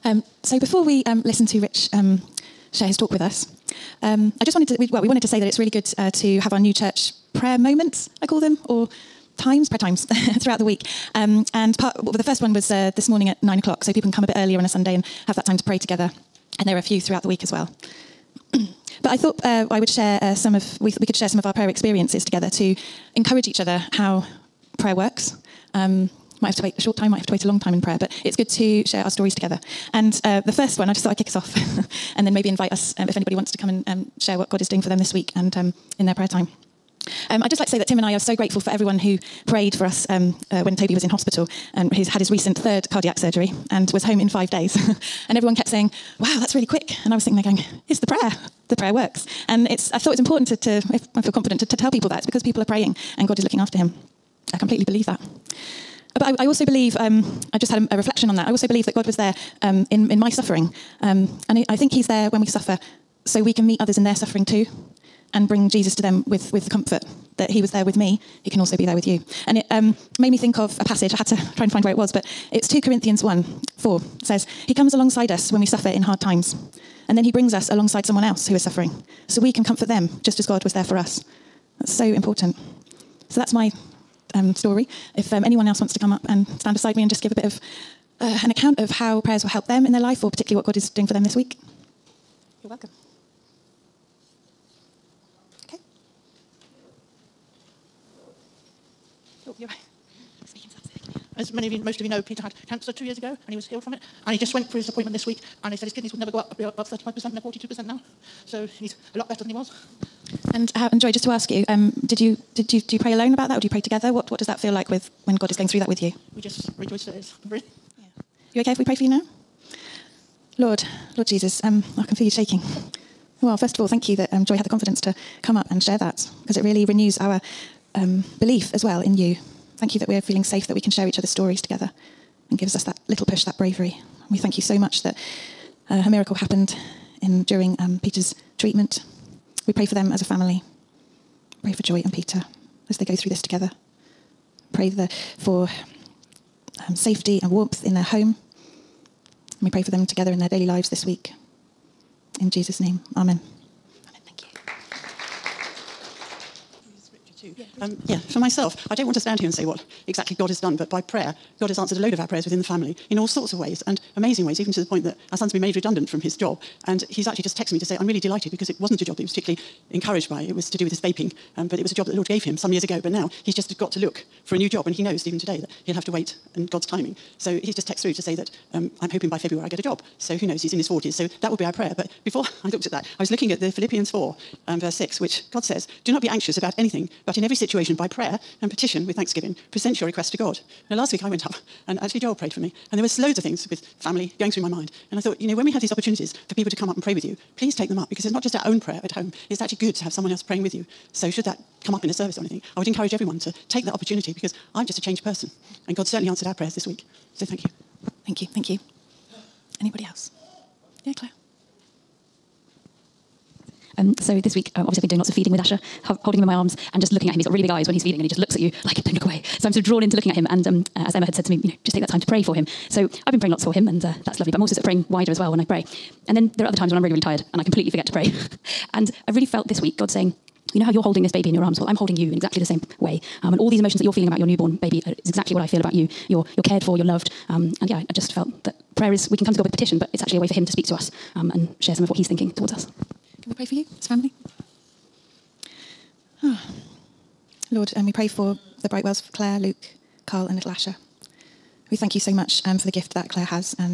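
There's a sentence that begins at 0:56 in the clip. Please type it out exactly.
But I, I also believe, um, I just had a, a, reflection on that.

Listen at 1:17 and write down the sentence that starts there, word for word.
And then he brings us alongside someone else who is suffering.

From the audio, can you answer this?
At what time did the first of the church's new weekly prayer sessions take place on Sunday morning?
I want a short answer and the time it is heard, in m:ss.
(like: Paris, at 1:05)
9 o'clock, at 0:13.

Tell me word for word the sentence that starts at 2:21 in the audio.
Pray for Joy and Peter as they go through this together.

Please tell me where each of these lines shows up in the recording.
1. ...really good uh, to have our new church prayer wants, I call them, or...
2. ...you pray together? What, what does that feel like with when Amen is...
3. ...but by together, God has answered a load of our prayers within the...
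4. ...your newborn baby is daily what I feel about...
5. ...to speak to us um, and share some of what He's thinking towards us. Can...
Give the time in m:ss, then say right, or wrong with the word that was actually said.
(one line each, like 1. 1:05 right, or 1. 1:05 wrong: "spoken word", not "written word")
1. 0:05 wrong: "moments", not "wants"
2. 1:53 wrong: "God", not "Amen"
3. 2:40 wrong: "prayer", not "together"
4. 3:54 wrong: "exactly", not "daily"
5. 4:00 right.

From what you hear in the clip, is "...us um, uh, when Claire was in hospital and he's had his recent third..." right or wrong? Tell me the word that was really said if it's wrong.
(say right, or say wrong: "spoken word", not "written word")
wrong: "Toby", not "Claire".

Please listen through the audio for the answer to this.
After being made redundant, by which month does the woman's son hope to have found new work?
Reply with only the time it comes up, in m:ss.
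2:59.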